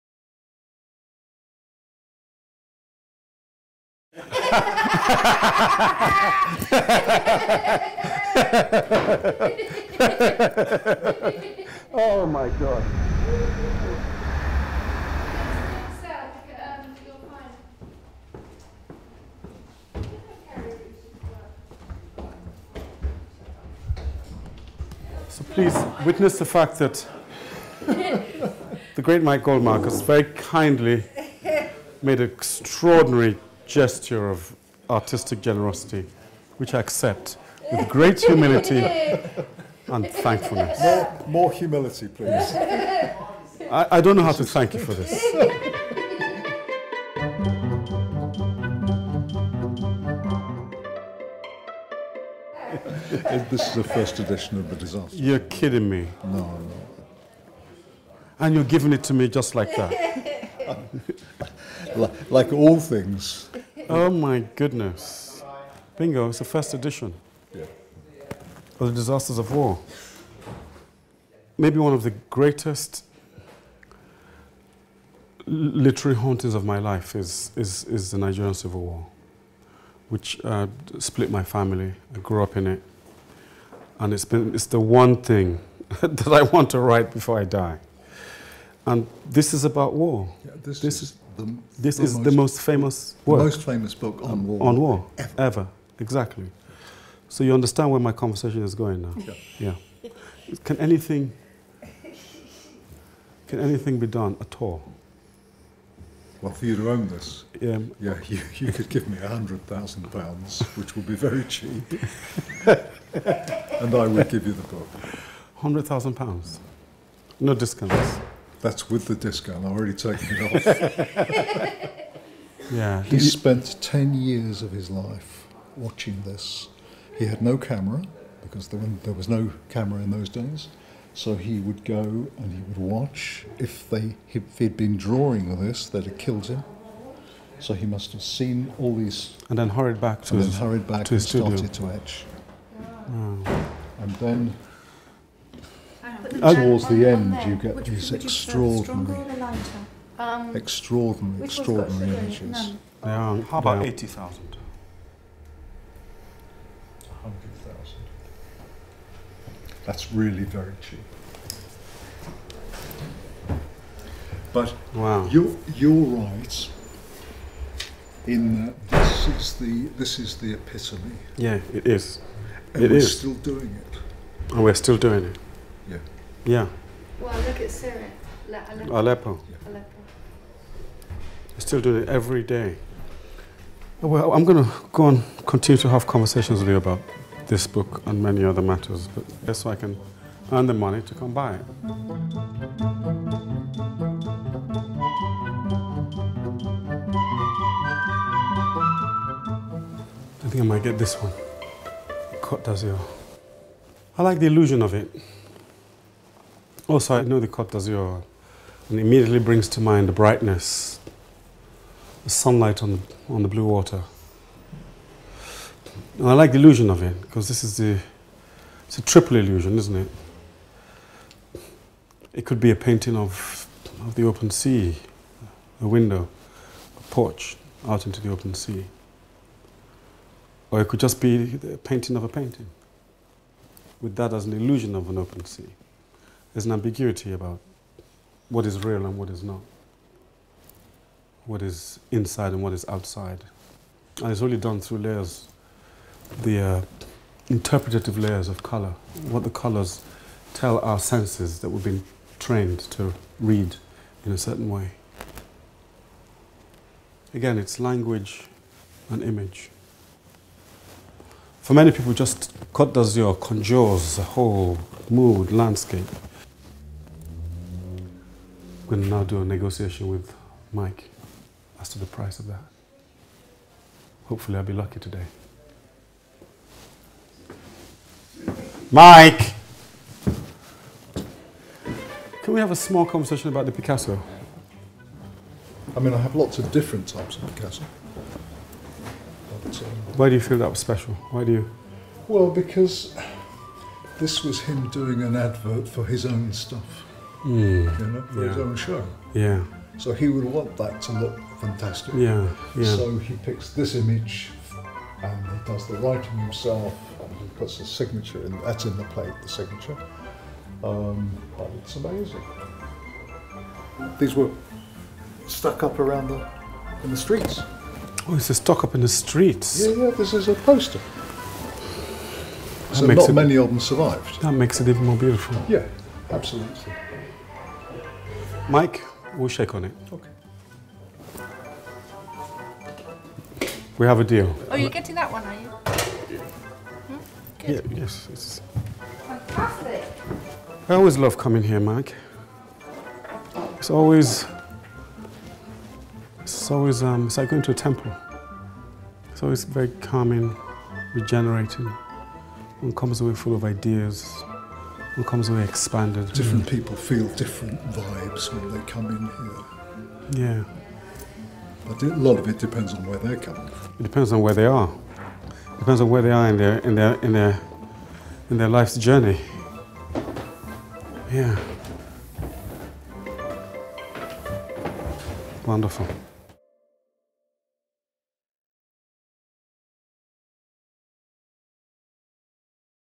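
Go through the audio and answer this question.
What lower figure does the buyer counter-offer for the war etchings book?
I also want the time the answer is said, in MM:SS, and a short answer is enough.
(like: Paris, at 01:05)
80,000, at 02:33.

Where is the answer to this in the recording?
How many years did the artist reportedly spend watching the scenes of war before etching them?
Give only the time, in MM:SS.
02:03.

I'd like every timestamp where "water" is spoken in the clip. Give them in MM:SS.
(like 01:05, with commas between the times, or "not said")
03:33.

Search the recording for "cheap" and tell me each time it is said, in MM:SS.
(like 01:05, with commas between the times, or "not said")
01:51, 02:40.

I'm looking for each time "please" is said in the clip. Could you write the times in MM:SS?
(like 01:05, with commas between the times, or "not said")
00:25, 00:42.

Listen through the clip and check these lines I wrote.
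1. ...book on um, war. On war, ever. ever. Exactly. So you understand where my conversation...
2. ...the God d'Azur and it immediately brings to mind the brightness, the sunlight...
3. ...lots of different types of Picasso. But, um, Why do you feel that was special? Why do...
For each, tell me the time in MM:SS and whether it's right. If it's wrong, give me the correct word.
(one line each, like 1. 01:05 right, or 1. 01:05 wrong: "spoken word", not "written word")
1. 01:33 right
2. 03:27 wrong: "Côte", not "God"
3. 04:46 right.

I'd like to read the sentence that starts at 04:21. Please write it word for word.
For many people, just does your conjures a whole mood, landscape.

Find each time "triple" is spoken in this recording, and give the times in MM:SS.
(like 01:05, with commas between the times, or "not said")
03:39.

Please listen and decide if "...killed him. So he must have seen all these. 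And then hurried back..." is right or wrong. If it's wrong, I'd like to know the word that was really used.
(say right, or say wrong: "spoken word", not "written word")
right.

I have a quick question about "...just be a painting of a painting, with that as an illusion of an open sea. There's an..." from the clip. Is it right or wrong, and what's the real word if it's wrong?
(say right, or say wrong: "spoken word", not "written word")
right.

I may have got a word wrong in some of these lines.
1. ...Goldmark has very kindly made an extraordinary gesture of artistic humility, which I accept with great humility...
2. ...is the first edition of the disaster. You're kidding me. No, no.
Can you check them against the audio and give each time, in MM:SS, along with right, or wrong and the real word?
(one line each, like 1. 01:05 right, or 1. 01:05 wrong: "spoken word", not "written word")
1. 00:29 wrong: "generosity", not "humility"
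2. 00:53 right.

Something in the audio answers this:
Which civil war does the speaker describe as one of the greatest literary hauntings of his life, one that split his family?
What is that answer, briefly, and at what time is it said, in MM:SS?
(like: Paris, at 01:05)
Nigerian Civil War, at 01:18.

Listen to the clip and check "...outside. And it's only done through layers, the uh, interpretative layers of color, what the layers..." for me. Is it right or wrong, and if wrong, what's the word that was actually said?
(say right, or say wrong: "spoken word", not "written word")
wrong: "colors", not "layers".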